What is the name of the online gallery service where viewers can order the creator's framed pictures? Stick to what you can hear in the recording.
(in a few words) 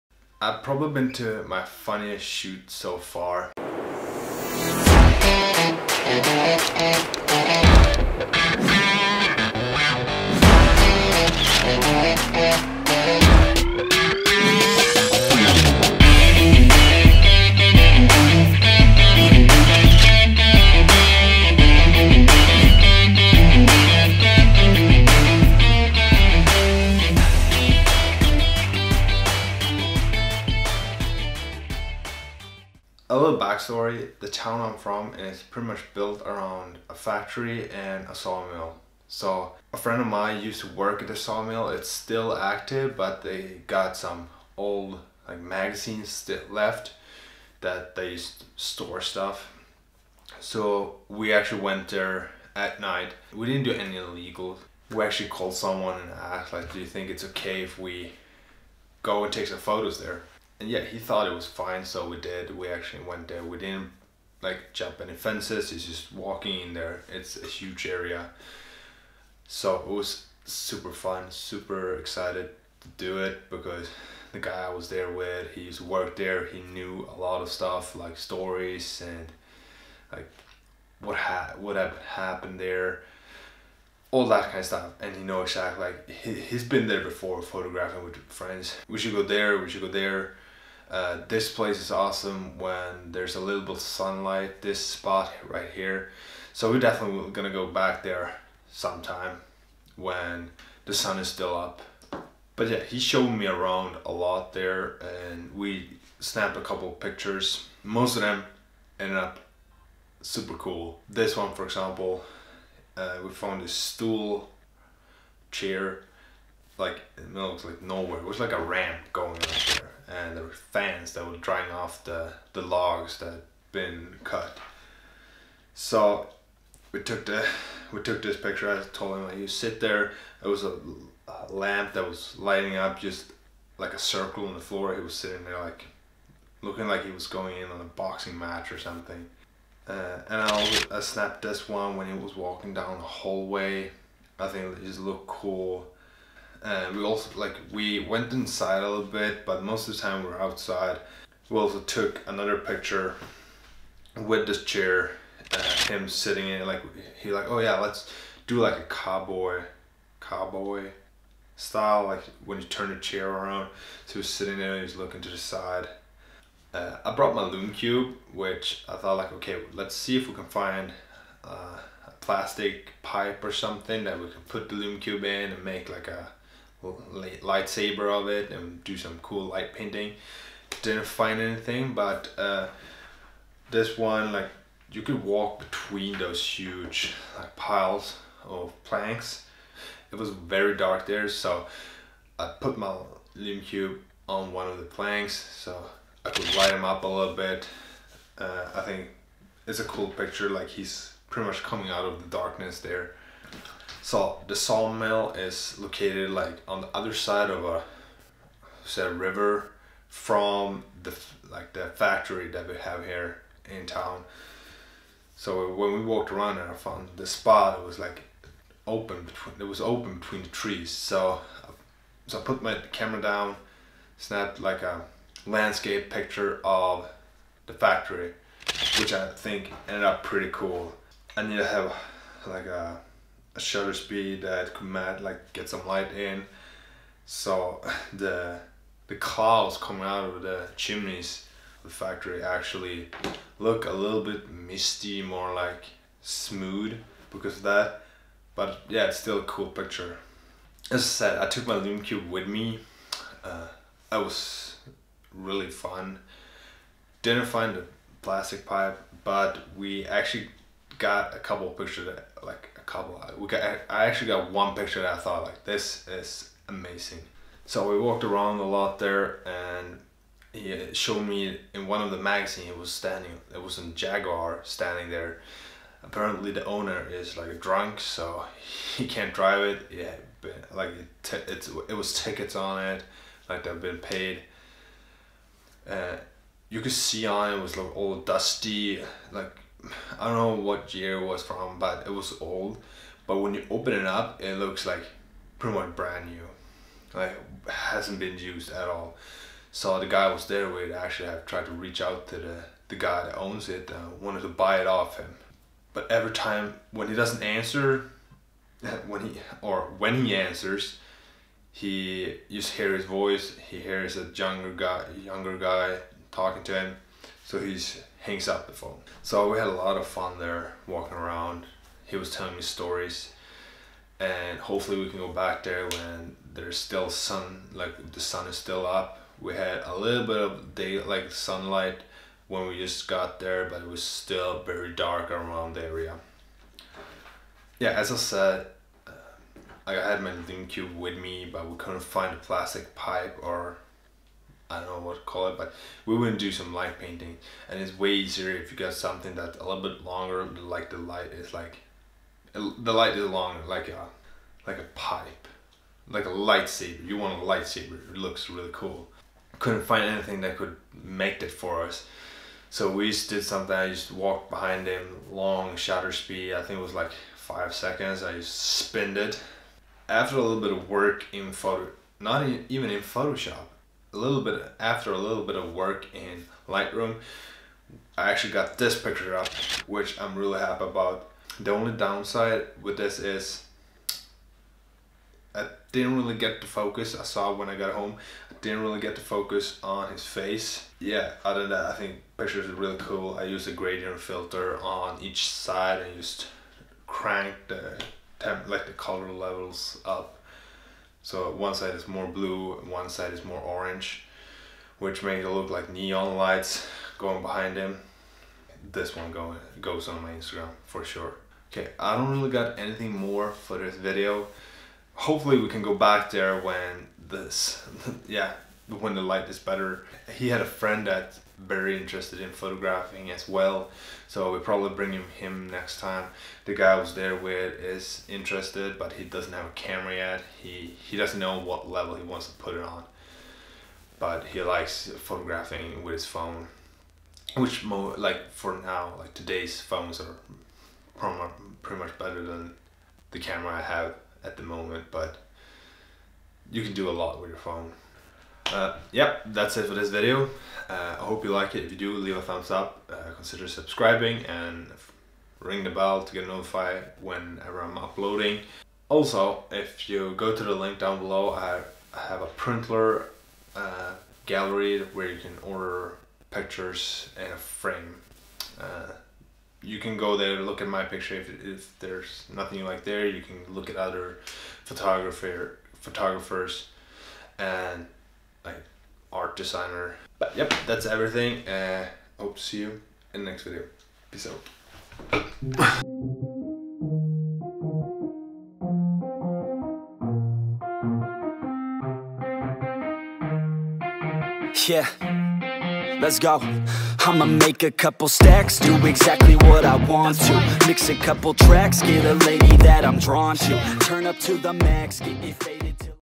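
Printler.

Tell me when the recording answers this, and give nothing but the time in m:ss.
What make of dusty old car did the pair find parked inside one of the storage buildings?
4:33.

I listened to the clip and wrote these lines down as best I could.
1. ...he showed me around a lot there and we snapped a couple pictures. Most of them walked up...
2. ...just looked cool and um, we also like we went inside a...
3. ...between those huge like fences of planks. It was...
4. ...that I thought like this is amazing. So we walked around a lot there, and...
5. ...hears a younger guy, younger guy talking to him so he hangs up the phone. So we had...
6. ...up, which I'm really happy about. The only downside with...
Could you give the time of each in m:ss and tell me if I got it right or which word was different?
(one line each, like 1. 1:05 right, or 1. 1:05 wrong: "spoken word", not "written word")
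1. 1:42 wrong: "ended", not "walked"
2. 2:24 right
3. 3:05 wrong: "piles", not "fences"
4. 4:25 right
5. 5:13 right
6. 6:19 right.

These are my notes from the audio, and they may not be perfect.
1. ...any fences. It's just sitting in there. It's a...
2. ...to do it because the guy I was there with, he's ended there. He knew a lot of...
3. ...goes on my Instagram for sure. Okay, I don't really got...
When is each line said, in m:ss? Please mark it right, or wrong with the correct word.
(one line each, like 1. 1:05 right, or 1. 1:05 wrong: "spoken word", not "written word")
1. 1:05 wrong: "walking", not "sitting"
2. 1:12 wrong: "worked", not "ended"
3. 6:49 right.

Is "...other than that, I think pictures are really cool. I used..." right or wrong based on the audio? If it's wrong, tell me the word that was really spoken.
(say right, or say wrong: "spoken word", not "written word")
right.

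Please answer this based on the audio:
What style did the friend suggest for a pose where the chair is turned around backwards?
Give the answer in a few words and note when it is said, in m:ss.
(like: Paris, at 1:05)
cowboy style, at 2:40.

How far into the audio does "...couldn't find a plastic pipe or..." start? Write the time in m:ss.
5:41.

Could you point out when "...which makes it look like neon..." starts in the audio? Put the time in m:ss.
6:44.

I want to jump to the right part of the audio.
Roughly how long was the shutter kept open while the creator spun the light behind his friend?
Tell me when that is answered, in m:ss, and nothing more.
6:07.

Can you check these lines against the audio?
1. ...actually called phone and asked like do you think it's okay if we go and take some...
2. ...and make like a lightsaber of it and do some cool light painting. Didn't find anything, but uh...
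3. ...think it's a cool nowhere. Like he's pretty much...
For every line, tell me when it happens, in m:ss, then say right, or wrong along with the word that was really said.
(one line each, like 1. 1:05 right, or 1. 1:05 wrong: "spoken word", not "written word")
1. 0:55 wrong: "someone", not "phone"
2. 2:55 right
3. 3:18 wrong: "picture", not "nowhere".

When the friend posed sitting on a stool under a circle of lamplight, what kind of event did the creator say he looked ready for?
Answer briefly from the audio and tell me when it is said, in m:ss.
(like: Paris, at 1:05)
boxing match, at 2:17.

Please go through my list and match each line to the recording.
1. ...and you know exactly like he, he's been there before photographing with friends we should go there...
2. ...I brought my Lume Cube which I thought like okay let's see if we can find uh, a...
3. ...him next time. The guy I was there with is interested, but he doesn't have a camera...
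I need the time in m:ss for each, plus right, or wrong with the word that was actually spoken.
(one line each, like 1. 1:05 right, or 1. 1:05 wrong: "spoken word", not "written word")
1. 1:24 right
2. 2:47 right
3. 7:05 right.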